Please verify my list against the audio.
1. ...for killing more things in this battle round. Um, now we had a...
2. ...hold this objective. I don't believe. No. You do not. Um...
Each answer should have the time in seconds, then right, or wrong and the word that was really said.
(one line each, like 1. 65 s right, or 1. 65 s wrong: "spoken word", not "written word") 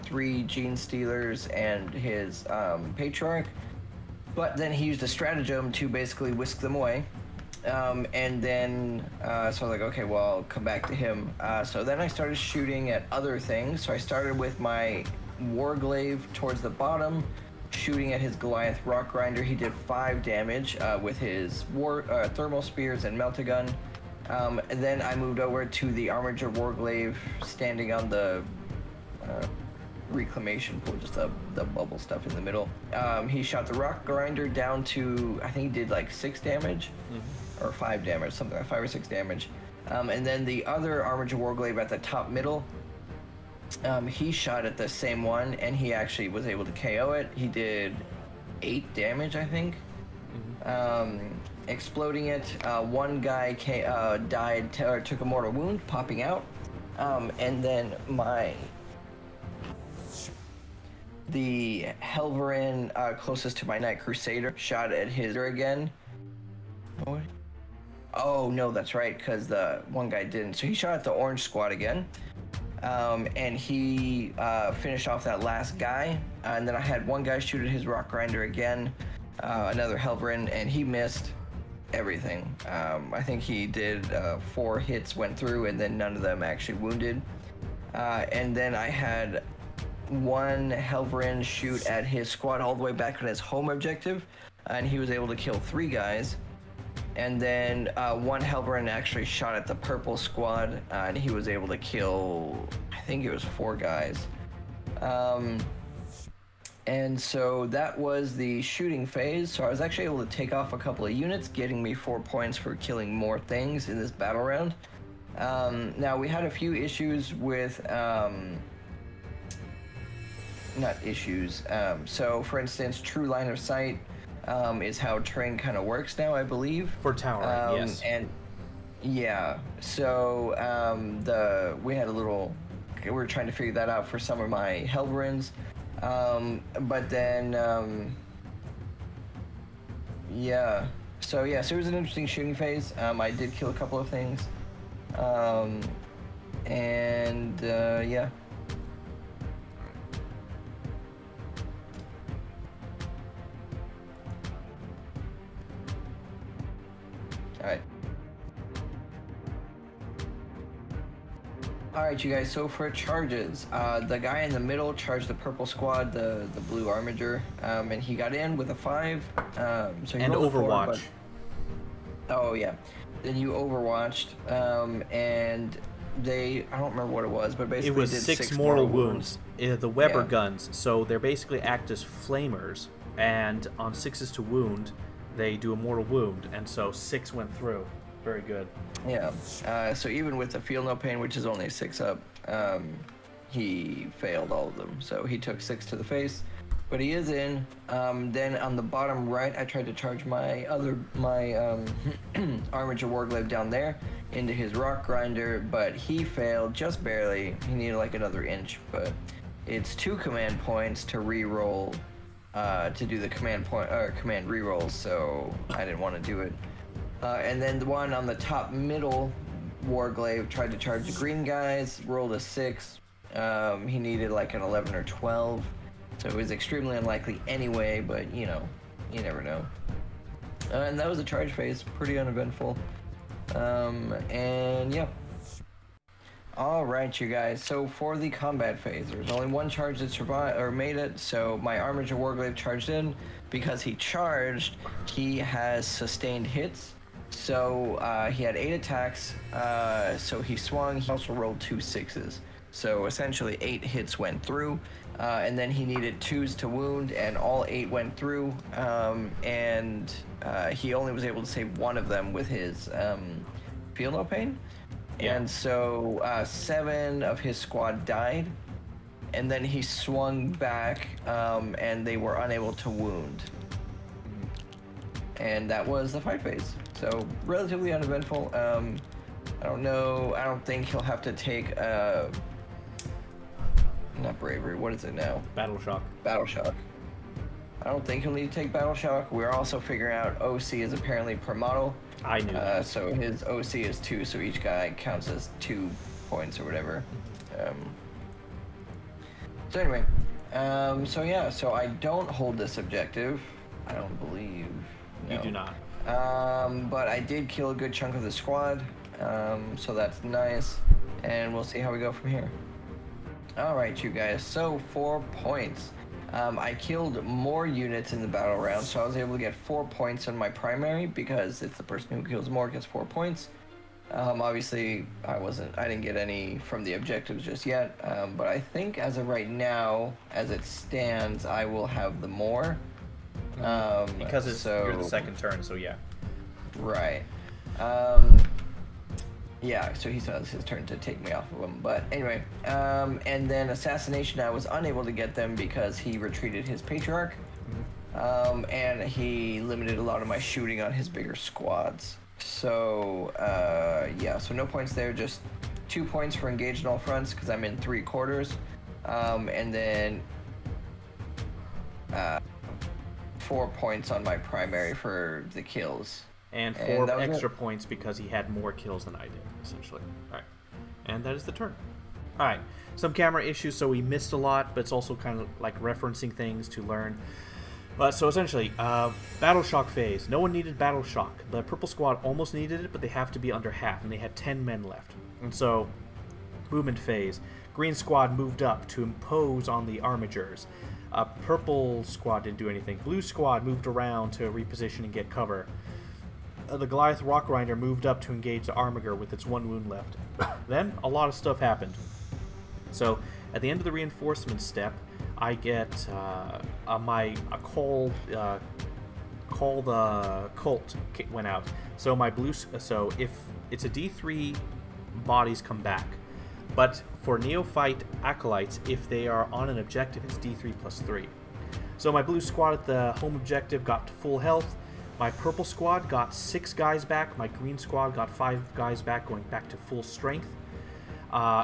1. 112 s right
2. 302 s right.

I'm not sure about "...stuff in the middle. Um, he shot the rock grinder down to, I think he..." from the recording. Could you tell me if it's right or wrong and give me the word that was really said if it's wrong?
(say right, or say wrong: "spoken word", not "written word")
right.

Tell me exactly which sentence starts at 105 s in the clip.
Um, and so that was the shooting phase.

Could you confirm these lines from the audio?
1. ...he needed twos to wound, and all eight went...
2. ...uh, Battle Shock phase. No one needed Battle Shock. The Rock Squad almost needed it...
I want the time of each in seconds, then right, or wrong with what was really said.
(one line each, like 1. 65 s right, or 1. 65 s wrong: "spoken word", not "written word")
1. 255 s right
2. 378 s wrong: "Purple", not "Rock".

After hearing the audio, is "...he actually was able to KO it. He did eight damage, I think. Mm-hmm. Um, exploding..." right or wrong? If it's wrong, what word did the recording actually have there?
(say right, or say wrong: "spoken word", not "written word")
right.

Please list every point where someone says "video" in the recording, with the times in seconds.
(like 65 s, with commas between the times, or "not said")
not said.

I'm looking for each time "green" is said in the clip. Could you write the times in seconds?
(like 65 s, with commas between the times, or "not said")
221 s, 387 s, 427 s.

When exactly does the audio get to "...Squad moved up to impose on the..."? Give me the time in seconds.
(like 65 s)
387 s.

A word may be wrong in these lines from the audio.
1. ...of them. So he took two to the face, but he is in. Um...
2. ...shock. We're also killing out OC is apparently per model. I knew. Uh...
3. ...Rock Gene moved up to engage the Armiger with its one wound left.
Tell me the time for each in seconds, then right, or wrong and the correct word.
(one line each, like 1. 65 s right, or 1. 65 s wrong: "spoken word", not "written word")
1. 194 s wrong: "six", not "two"
2. 288 s wrong: "figuring", not "killing"
3. 397 s wrong: "Grinder", not "Gene".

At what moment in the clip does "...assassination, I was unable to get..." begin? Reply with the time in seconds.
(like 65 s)
343 s.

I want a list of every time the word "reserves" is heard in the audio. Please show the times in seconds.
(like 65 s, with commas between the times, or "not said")
not said.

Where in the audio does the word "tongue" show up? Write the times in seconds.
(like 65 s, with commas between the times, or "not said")
not said.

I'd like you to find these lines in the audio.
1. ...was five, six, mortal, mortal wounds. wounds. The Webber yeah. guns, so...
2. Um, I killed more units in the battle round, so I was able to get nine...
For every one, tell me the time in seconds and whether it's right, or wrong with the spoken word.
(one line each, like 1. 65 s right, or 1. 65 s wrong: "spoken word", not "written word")
1. 177 s wrong: "six", not "five"
2. 316 s wrong: "four", not "nine".